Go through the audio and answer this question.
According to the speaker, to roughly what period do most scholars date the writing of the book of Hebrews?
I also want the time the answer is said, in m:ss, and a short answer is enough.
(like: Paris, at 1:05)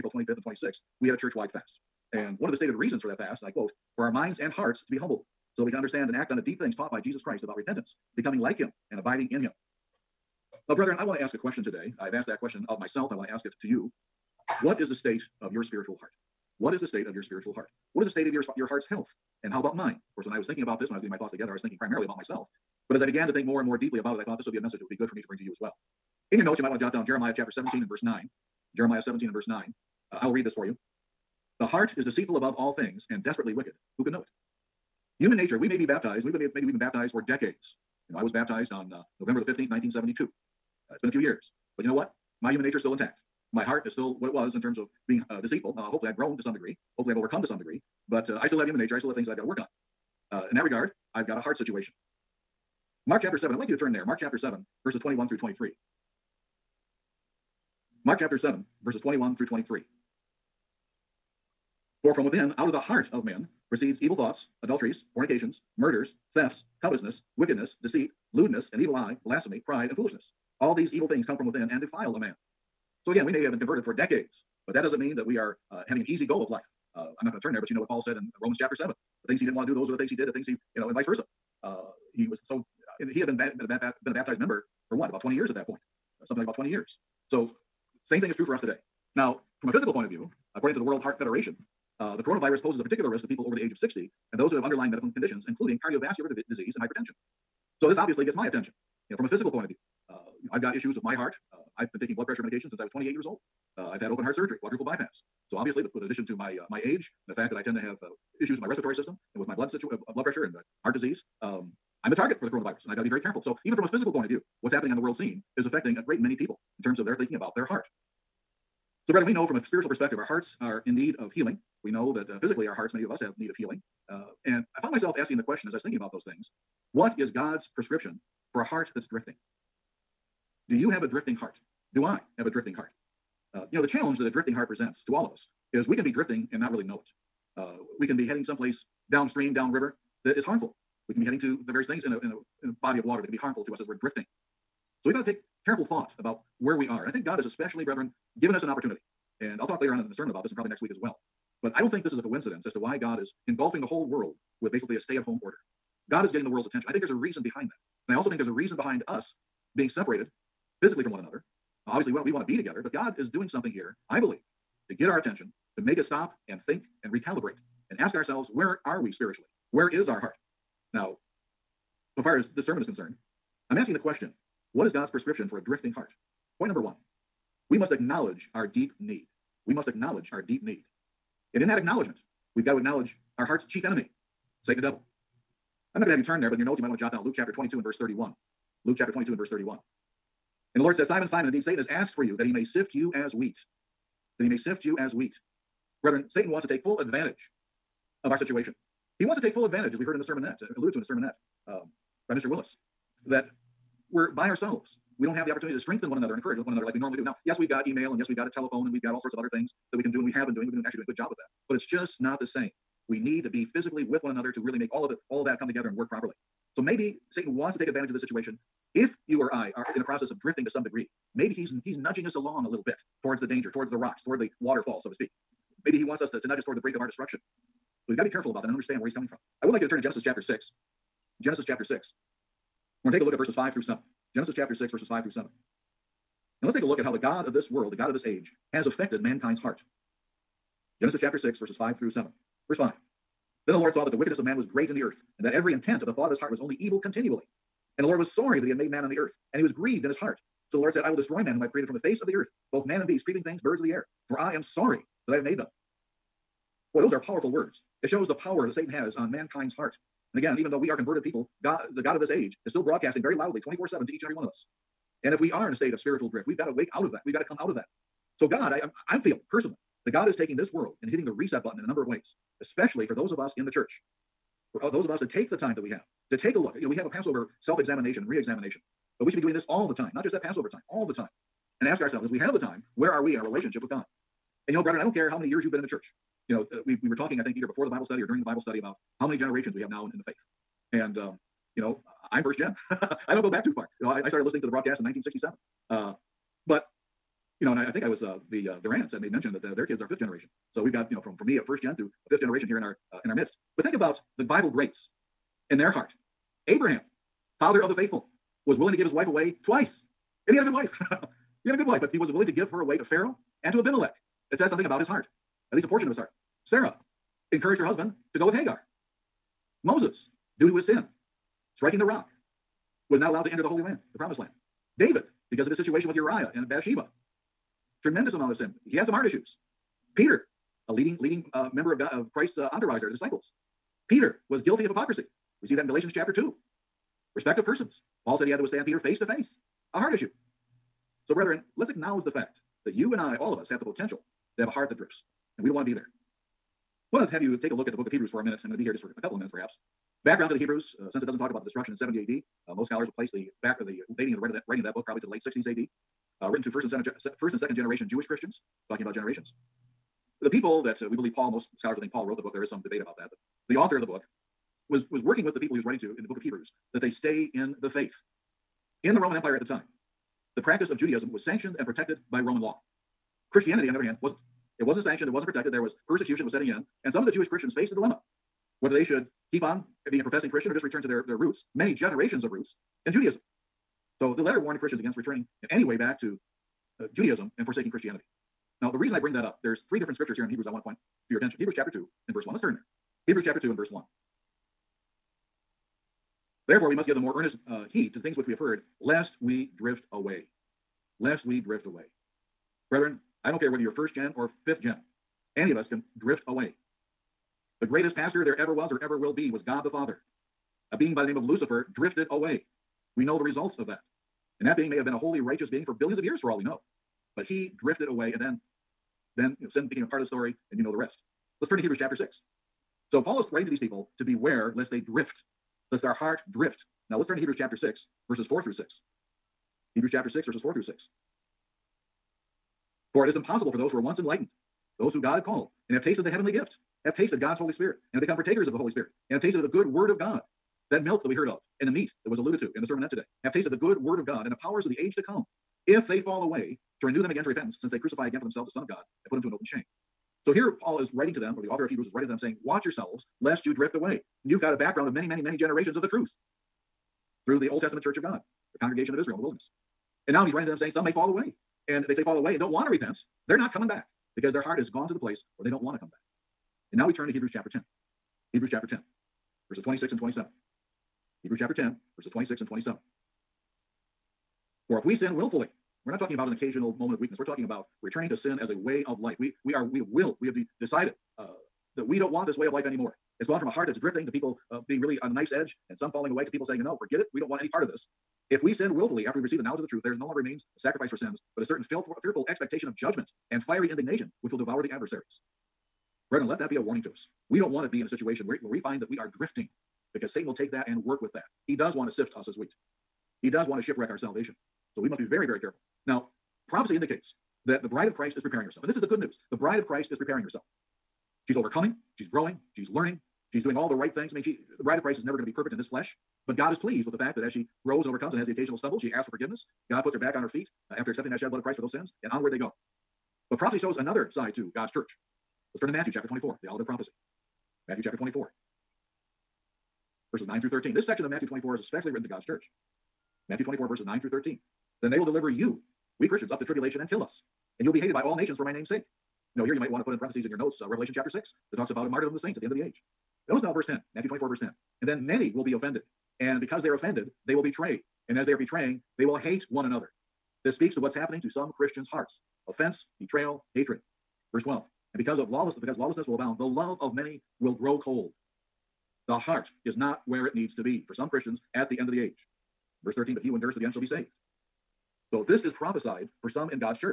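Late 60s AD, at 5:55.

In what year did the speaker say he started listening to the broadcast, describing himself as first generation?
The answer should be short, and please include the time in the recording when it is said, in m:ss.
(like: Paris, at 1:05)
1967, at 4:55.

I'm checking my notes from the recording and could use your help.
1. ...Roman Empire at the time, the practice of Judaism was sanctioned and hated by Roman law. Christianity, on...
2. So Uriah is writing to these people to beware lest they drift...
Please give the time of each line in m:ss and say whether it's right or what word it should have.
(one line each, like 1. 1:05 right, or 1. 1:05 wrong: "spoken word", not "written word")
1. 6:09 wrong: "protected", not "hated"
2. 7:03 wrong: "Paul", not "Uriah".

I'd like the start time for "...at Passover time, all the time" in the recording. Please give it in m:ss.
4:40.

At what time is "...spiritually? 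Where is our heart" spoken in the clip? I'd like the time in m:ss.
2:49.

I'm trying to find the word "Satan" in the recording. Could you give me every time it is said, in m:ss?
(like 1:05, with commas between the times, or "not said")
3:04, 3:11, 3:16, 3:37, 4:18, 8:20.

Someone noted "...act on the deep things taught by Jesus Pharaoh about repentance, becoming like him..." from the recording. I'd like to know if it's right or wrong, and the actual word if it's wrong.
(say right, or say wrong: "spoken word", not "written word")
wrong: "Christ", not "Pharaoh".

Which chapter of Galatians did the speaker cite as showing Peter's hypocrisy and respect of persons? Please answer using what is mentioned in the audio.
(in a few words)
Chapter 2.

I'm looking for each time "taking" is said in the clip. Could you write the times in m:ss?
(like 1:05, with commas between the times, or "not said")
1:42, 4:30.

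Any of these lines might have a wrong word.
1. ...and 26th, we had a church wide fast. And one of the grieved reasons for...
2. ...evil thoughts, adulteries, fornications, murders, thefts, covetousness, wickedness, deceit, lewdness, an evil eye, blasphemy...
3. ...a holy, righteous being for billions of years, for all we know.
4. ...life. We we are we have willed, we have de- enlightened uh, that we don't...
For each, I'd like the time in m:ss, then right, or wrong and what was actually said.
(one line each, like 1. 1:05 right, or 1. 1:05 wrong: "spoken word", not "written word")
1. 0:00 wrong: "stated", not "grieved"
2. 1:04 right
3. 6:55 right
4. 7:59 wrong: "decided", not "enlightened".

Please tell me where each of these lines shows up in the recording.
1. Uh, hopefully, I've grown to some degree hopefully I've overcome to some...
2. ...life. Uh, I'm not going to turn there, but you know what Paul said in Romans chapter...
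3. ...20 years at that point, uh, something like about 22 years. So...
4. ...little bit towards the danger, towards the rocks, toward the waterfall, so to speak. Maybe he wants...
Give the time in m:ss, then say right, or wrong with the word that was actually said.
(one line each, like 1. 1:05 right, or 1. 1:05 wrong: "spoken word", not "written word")
1. 0:45 right
2. 1:16 right
3. 1:25 wrong: "20", not "22"
4. 3:42 right.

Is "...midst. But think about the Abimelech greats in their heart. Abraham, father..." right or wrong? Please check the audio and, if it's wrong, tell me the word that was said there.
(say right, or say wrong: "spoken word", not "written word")
wrong: "Bible", not "Abimelech".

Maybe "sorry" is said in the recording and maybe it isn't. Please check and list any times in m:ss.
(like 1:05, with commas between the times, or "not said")
4:08, 4:14.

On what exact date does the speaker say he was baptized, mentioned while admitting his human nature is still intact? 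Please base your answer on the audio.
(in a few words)
November 15, 1972.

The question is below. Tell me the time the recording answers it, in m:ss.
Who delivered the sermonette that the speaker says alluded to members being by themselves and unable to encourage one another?
3:22.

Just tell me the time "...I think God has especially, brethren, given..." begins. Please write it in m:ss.
2:27.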